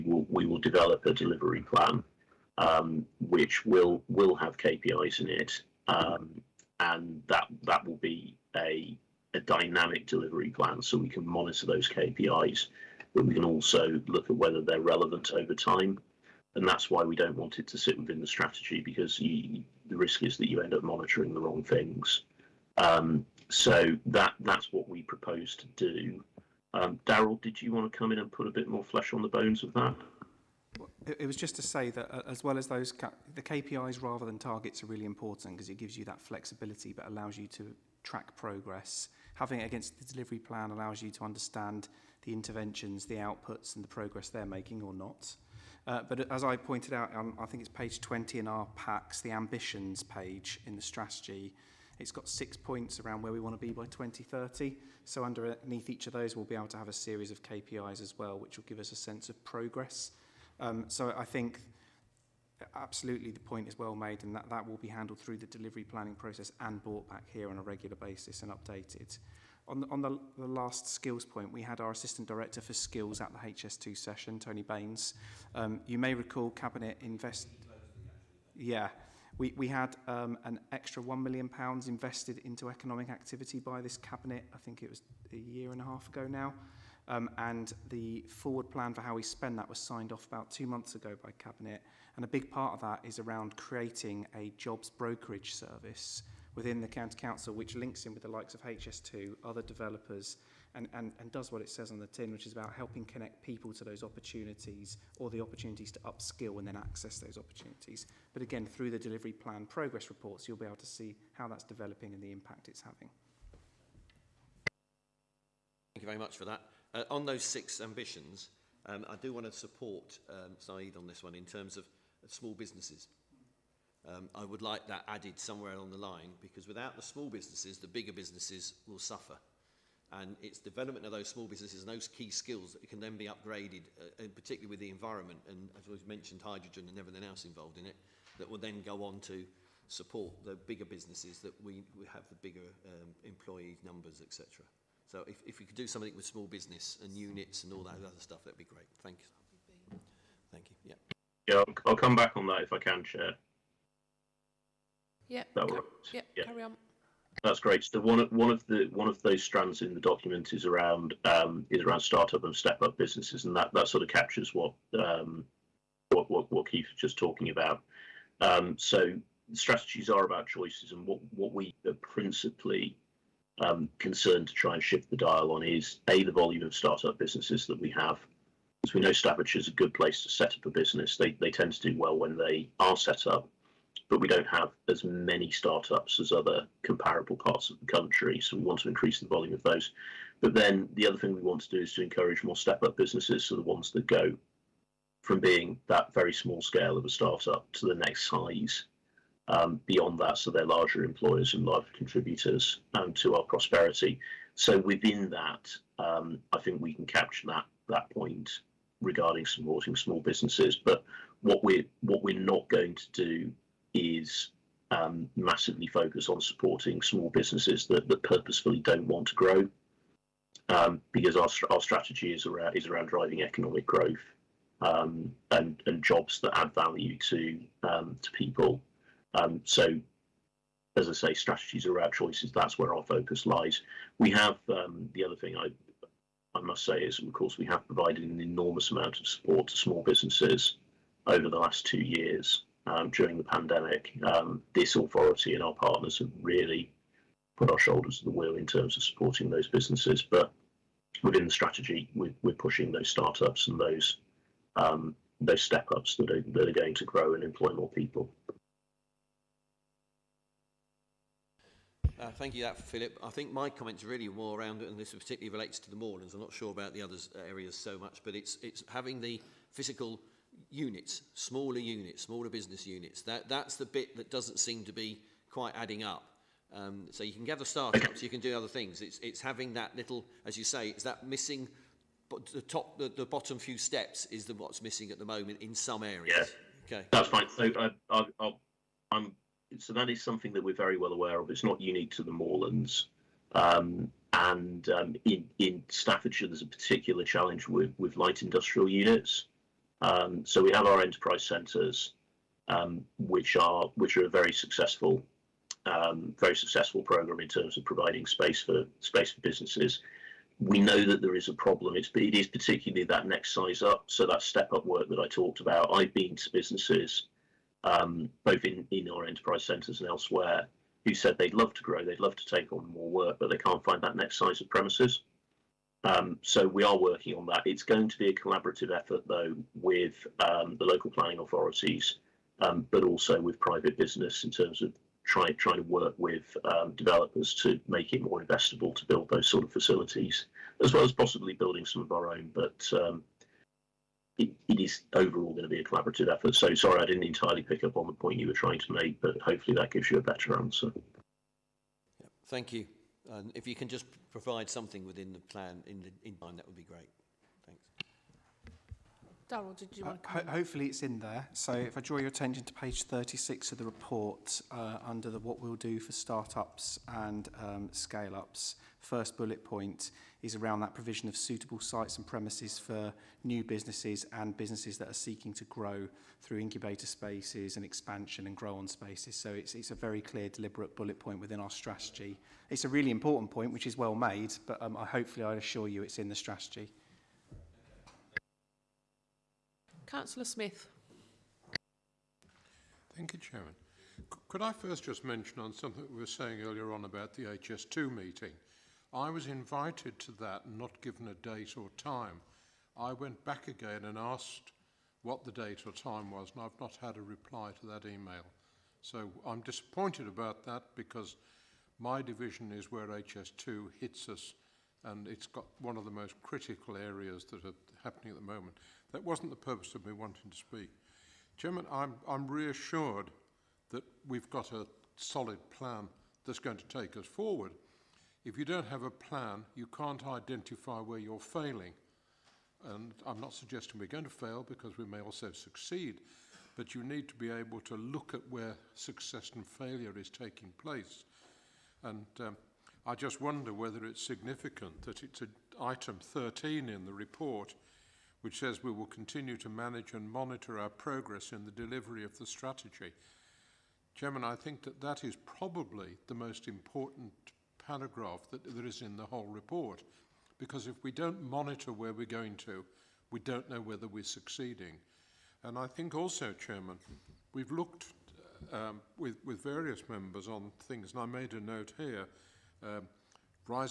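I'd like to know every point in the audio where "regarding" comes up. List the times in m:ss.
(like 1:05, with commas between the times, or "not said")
3:29.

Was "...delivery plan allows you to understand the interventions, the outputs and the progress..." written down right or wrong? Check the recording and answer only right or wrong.
right.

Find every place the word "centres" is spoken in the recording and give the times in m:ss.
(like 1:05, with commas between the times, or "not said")
5:01, 5:19.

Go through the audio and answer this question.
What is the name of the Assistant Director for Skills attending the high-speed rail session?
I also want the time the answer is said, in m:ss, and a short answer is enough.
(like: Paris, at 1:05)
Tony Baines, at 1:14.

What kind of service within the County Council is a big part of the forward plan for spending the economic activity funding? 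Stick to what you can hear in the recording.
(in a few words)
jobs brokerage service.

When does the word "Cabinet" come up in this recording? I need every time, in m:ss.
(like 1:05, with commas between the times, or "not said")
1:16, 1:23, 1:31.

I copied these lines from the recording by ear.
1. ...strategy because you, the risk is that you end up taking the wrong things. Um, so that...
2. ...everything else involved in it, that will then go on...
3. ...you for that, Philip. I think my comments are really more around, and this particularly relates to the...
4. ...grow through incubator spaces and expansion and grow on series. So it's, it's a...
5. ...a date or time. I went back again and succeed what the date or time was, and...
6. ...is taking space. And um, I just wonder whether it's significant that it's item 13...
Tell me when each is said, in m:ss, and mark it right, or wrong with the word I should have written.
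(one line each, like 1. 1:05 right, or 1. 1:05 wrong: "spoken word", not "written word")
1. 0:18 wrong: "monitoring", not "taking"
2. 2:16 right
3. 4:22 right
4. 6:15 wrong: "spaces", not "series"
5. 6:41 wrong: "asked", not "succeed"
6. 7:20 wrong: "place", not "space".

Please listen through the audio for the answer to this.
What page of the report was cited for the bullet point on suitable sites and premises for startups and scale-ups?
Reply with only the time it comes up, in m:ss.
6:03.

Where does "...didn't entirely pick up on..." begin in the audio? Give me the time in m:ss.
5:47.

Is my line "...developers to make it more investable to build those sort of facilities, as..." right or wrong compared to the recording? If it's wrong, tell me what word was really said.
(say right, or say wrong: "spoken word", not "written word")
right.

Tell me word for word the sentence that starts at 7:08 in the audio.
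If you don't have a plan, you can't identify where you're failing.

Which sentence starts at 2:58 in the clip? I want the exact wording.
As we know, Staffordshire is a good place to set up a business.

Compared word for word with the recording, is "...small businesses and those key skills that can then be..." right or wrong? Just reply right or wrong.
right.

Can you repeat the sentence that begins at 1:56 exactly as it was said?
Uh, on those six ambitions, um, I do want to support um, Saeed on this one in terms of small businesses.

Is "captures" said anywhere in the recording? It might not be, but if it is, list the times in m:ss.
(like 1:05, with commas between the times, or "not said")
2:44, 3:27.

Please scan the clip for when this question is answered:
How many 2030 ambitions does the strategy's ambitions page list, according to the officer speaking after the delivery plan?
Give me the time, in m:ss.
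0:52.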